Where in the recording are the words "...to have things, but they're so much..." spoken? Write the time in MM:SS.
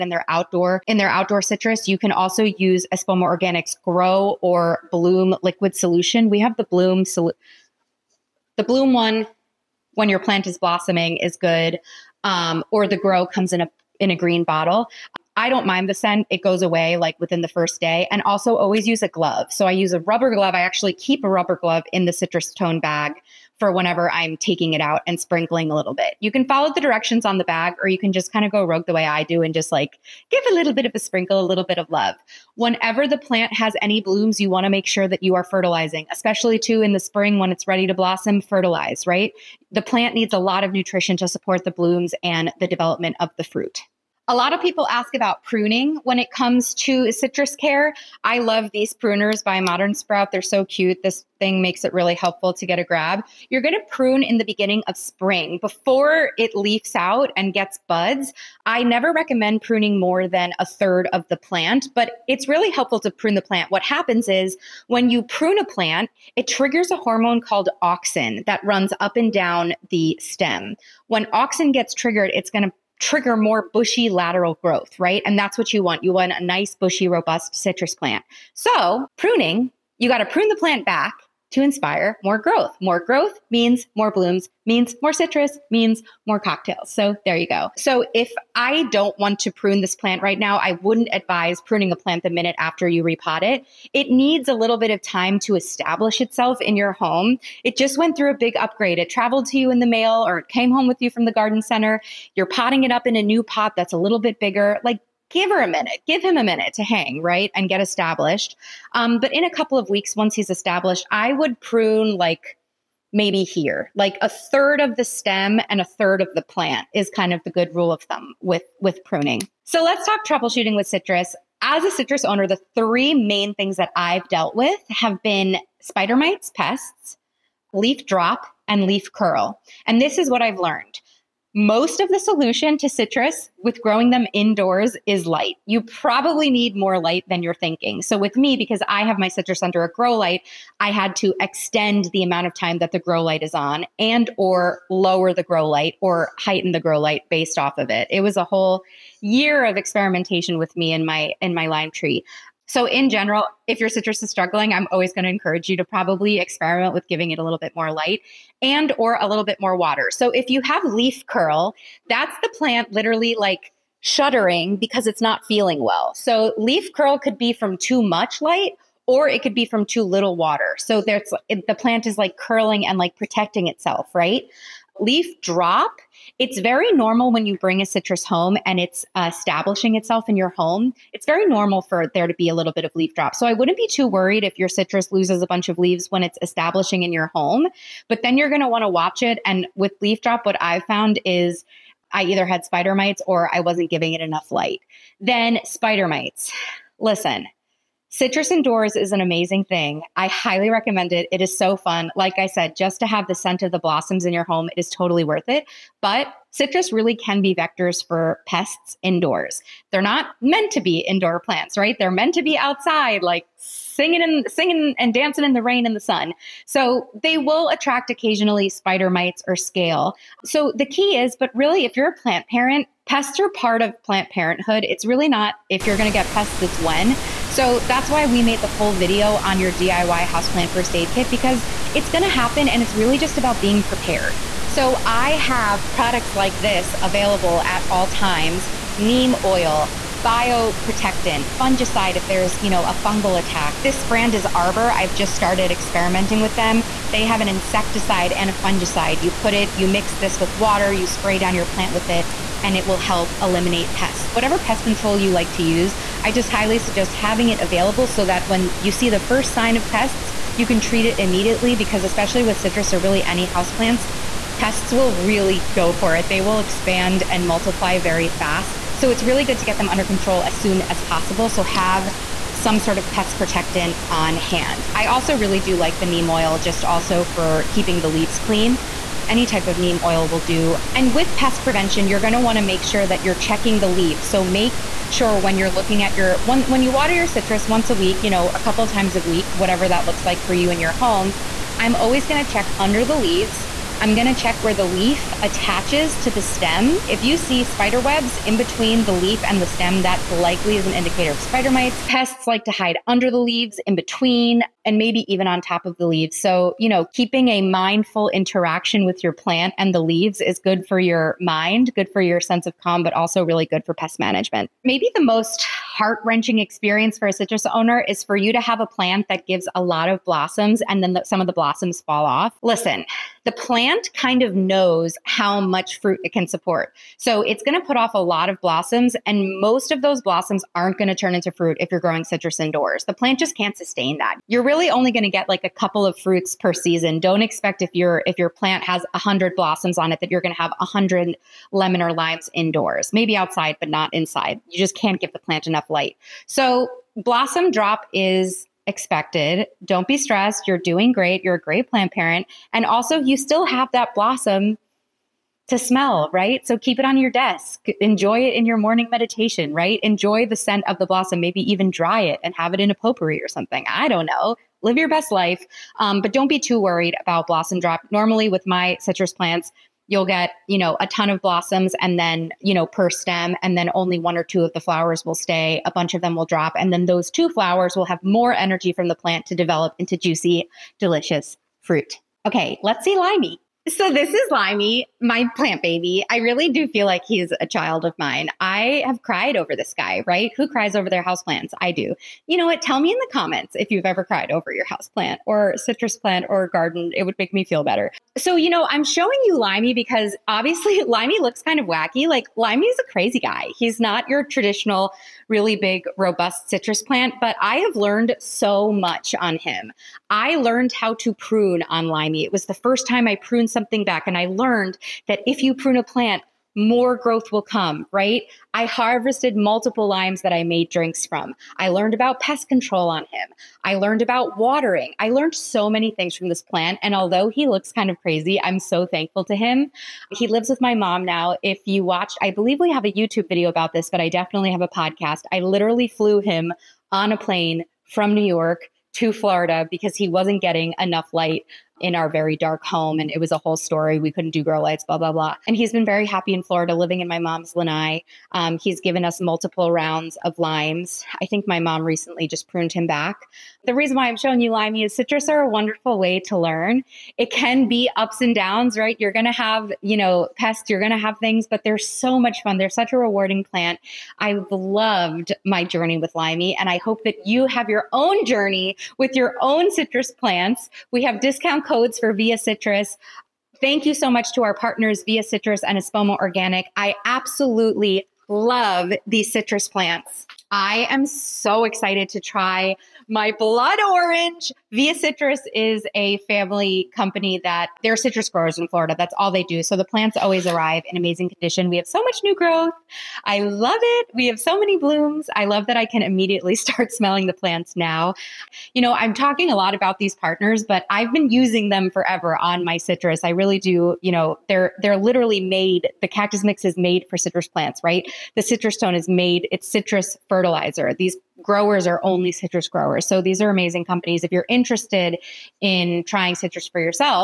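07:41.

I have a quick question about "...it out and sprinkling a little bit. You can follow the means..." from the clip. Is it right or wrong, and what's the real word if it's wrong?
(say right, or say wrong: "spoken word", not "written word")
wrong: "directions", not "means".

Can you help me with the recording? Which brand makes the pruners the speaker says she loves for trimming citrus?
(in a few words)
Modern Sprout.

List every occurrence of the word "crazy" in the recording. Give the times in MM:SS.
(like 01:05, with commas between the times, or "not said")
06:43, 07:08.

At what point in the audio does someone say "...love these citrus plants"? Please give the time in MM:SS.
07:58.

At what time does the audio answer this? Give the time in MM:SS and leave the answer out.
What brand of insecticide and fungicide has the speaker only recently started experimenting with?
04:04.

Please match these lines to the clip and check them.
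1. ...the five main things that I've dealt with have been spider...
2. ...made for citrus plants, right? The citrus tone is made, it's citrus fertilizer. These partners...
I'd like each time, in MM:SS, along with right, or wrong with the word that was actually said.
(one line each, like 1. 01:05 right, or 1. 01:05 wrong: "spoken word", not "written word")
1. 02:02 wrong: "three", not "five"
2. 08:26 wrong: "growers", not "partners".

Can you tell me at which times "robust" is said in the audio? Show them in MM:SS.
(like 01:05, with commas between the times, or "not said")
01:17, 06:46.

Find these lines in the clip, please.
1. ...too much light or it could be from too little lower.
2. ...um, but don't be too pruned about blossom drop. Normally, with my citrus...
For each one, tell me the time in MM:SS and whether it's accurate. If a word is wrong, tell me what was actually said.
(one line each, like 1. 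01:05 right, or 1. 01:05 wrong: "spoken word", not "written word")
1. 02:47 wrong: "water", not "lower"
2. 06:05 wrong: "worried", not "pruned".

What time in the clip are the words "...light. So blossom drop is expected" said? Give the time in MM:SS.
05:45.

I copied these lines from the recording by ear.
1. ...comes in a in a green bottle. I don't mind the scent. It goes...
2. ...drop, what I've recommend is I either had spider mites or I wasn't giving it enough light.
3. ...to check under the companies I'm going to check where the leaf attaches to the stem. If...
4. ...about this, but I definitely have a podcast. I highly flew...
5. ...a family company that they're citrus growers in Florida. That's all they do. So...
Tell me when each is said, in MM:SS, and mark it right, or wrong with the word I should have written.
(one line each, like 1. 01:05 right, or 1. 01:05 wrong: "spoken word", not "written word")
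1. 00:13 right
2. 03:10 wrong: "found", not "recommend"
3. 04:52 wrong: "leaves", not "companies"
4. 07:13 wrong: "literally", not "highly"
5. 08:06 right.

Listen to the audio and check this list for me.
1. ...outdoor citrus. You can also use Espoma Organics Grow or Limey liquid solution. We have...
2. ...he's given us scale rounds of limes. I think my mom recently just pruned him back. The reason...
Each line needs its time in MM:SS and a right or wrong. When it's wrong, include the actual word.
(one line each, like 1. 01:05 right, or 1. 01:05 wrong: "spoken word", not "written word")
1. 00:01 wrong: "Bloom", not "Limey"
2. 07:28 wrong: "multiple", not "scale".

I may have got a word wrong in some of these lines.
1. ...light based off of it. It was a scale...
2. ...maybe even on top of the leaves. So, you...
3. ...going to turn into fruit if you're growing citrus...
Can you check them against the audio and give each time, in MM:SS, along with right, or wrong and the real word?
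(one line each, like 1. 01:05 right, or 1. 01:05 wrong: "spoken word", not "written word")
1. 02:26 wrong: "whole", not "scale"
2. 05:04 right
3. 05:30 right.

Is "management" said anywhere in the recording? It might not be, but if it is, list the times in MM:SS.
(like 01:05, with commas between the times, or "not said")
05:14.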